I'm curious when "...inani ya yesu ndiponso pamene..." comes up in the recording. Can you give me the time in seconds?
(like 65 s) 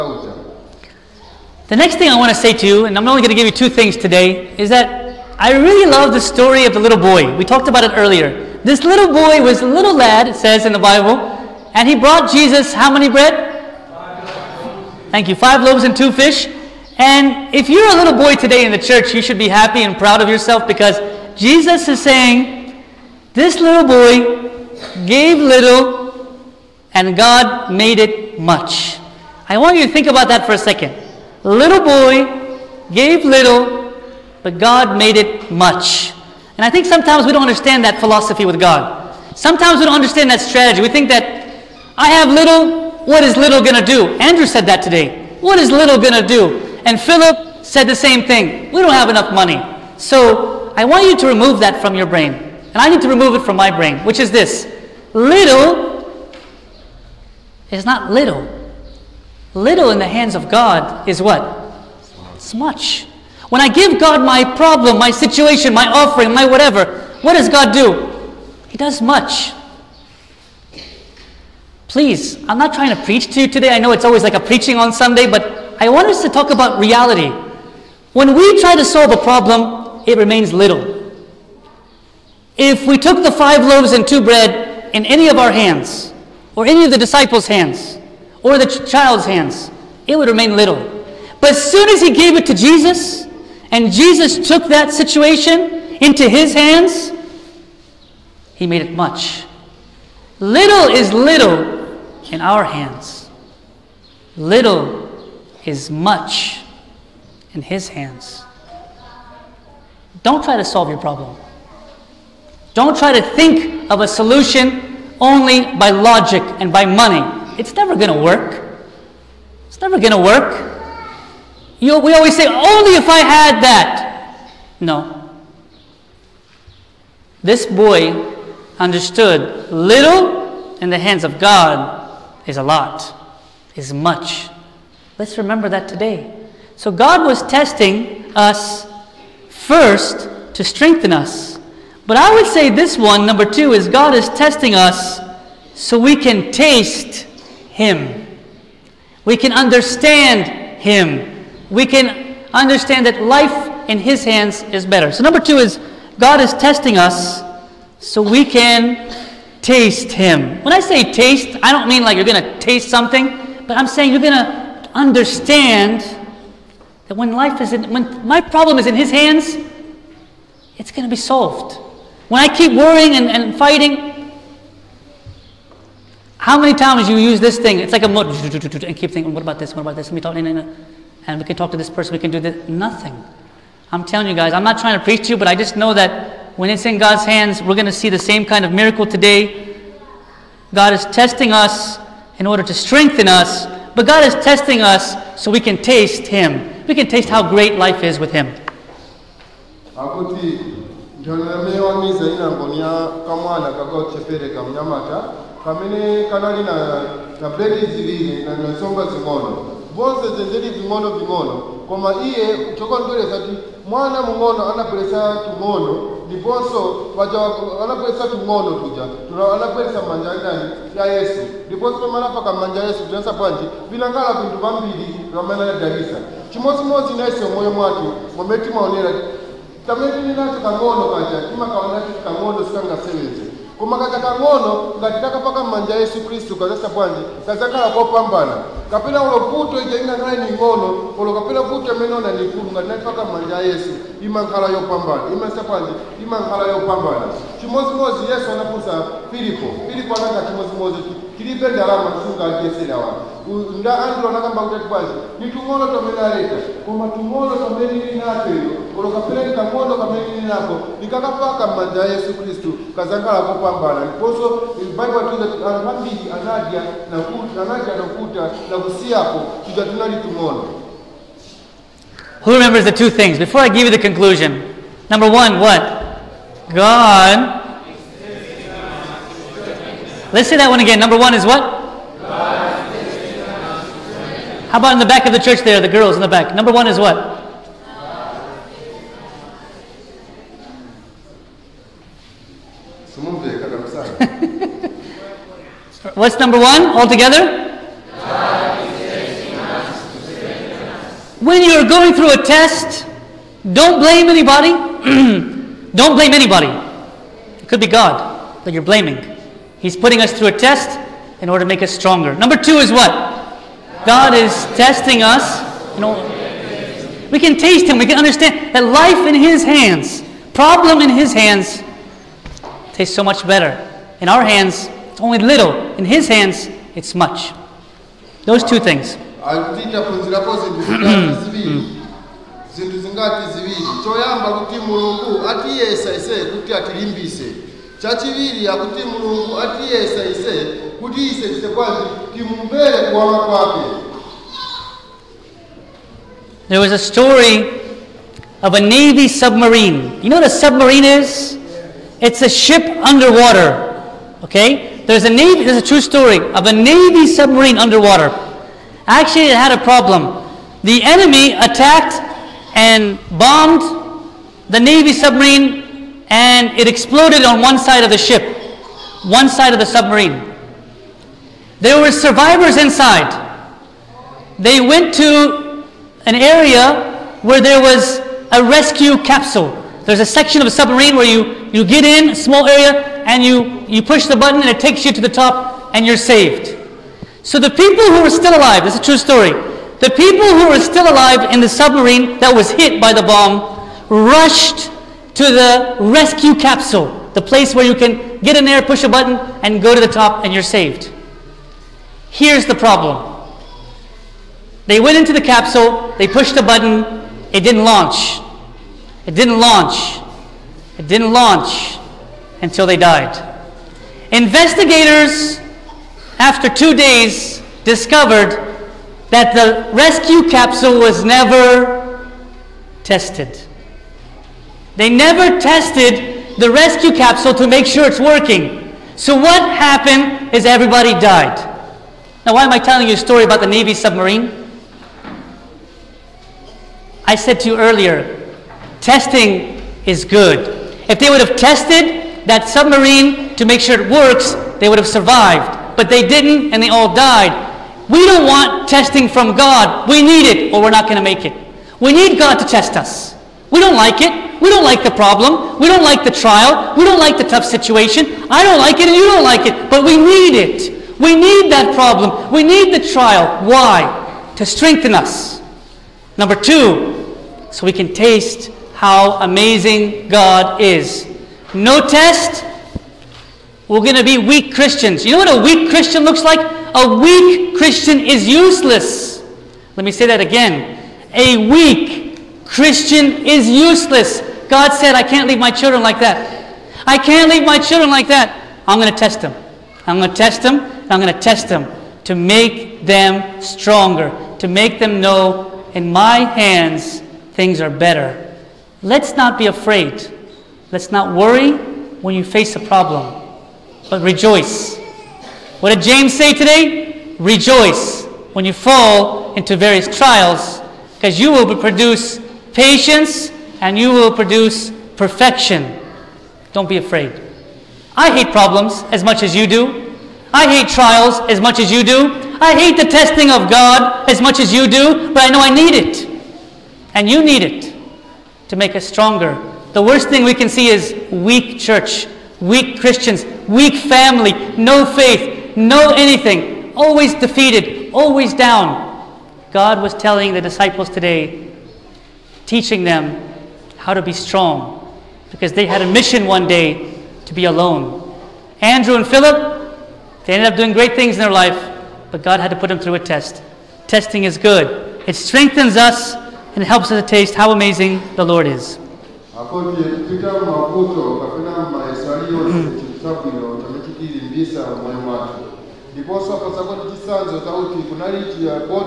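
220 s.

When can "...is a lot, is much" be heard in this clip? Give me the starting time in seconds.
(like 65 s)
132 s.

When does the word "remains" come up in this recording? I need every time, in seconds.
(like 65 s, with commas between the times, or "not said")
80 s, 90 s.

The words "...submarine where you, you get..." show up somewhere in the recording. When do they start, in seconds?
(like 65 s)
380 s.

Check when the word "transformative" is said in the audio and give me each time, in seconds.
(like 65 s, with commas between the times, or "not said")
not said.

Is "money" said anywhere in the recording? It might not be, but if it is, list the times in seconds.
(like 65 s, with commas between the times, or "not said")
49 s, 116 s.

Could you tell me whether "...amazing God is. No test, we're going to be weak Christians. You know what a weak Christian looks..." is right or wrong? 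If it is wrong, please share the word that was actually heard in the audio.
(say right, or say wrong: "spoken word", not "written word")
right.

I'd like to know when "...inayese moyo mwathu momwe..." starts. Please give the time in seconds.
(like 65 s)
227 s.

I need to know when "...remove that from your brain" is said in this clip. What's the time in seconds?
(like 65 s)
51 s.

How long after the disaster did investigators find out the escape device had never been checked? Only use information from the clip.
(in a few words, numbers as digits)
2 days.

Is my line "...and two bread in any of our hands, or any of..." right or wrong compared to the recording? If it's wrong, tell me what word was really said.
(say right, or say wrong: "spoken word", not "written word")
right.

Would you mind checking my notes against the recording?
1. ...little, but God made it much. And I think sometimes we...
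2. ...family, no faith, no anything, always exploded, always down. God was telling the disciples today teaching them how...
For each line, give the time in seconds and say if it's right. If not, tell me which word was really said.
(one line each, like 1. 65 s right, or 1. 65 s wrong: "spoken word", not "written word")
1. 33 s right
2. 534 s wrong: "defeated", not "exploded".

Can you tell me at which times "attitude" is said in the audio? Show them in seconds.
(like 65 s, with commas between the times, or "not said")
not said.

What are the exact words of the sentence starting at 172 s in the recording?
When I keep worrying and, and fighting, how many times you use this thing?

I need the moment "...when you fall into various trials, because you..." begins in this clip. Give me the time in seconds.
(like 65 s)
508 s.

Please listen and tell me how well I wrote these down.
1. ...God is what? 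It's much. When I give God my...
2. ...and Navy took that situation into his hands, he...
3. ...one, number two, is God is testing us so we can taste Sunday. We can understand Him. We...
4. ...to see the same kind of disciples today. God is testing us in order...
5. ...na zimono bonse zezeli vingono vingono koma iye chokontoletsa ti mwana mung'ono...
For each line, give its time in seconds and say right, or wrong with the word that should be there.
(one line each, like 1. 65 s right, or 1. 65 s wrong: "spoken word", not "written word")
1. 60 s right
2. 93 s wrong: "Jesus", not "Navy"
3. 142 s wrong: "Him", not "Sunday"
4. 187 s wrong: "miracle", not "disciples"
5. 208 s right.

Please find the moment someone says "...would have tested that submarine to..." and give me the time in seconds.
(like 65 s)
441 s.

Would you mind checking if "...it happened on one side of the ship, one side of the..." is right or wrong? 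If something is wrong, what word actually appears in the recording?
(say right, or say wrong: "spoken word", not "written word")
wrong: "exploded", not "happened".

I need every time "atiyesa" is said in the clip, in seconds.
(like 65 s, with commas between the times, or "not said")
335 s, 339 s.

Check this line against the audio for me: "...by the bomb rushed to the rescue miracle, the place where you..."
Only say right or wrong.
wrong.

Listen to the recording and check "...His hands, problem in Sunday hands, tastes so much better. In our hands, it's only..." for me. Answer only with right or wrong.
wrong.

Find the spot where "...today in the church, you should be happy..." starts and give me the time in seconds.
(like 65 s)
18 s.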